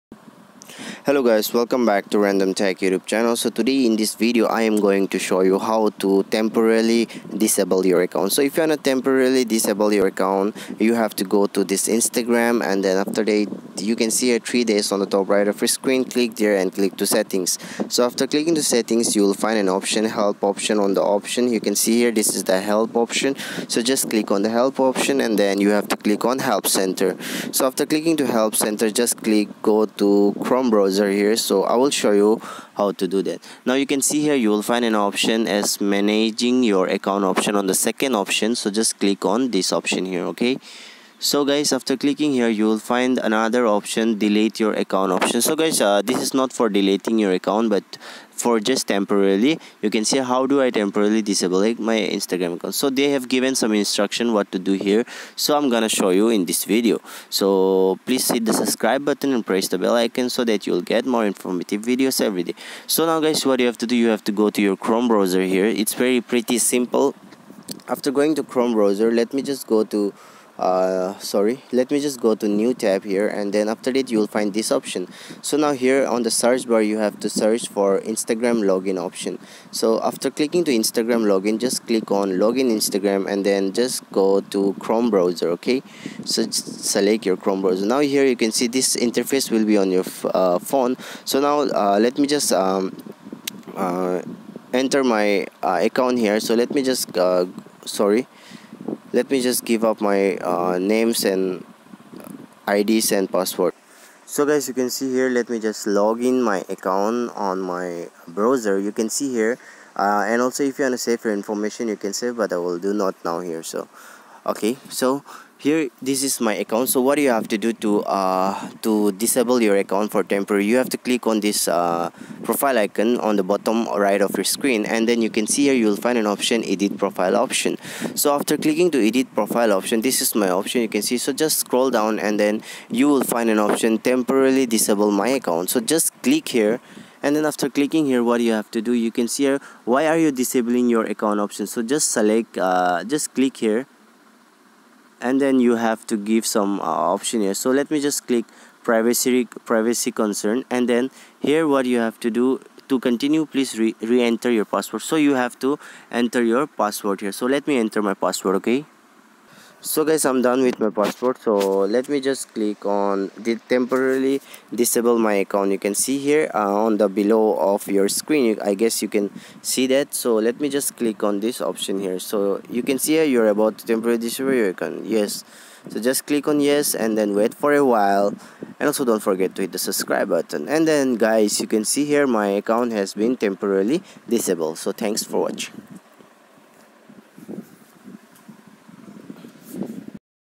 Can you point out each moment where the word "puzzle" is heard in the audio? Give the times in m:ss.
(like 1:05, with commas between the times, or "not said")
not said.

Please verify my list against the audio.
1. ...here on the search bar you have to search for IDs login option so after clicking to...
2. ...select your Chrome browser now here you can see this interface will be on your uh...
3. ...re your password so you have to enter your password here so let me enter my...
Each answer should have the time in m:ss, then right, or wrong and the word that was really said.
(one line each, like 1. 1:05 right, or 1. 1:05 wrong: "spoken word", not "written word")
1. 1:15 wrong: "Instagram", not "IDs"
2. 1:26 right
3. 2:34 right.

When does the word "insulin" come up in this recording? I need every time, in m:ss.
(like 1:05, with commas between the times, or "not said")
not said.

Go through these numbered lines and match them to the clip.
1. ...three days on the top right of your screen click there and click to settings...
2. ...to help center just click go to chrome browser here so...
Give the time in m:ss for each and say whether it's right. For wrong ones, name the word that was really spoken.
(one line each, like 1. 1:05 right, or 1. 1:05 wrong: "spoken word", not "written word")
1. 0:14 right
2. 0:28 right.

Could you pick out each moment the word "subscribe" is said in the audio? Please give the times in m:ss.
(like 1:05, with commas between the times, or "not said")
0:58, 2:59.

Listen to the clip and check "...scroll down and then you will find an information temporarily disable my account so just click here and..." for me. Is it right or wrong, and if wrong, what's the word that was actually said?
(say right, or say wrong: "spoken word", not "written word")
wrong: "option", not "information".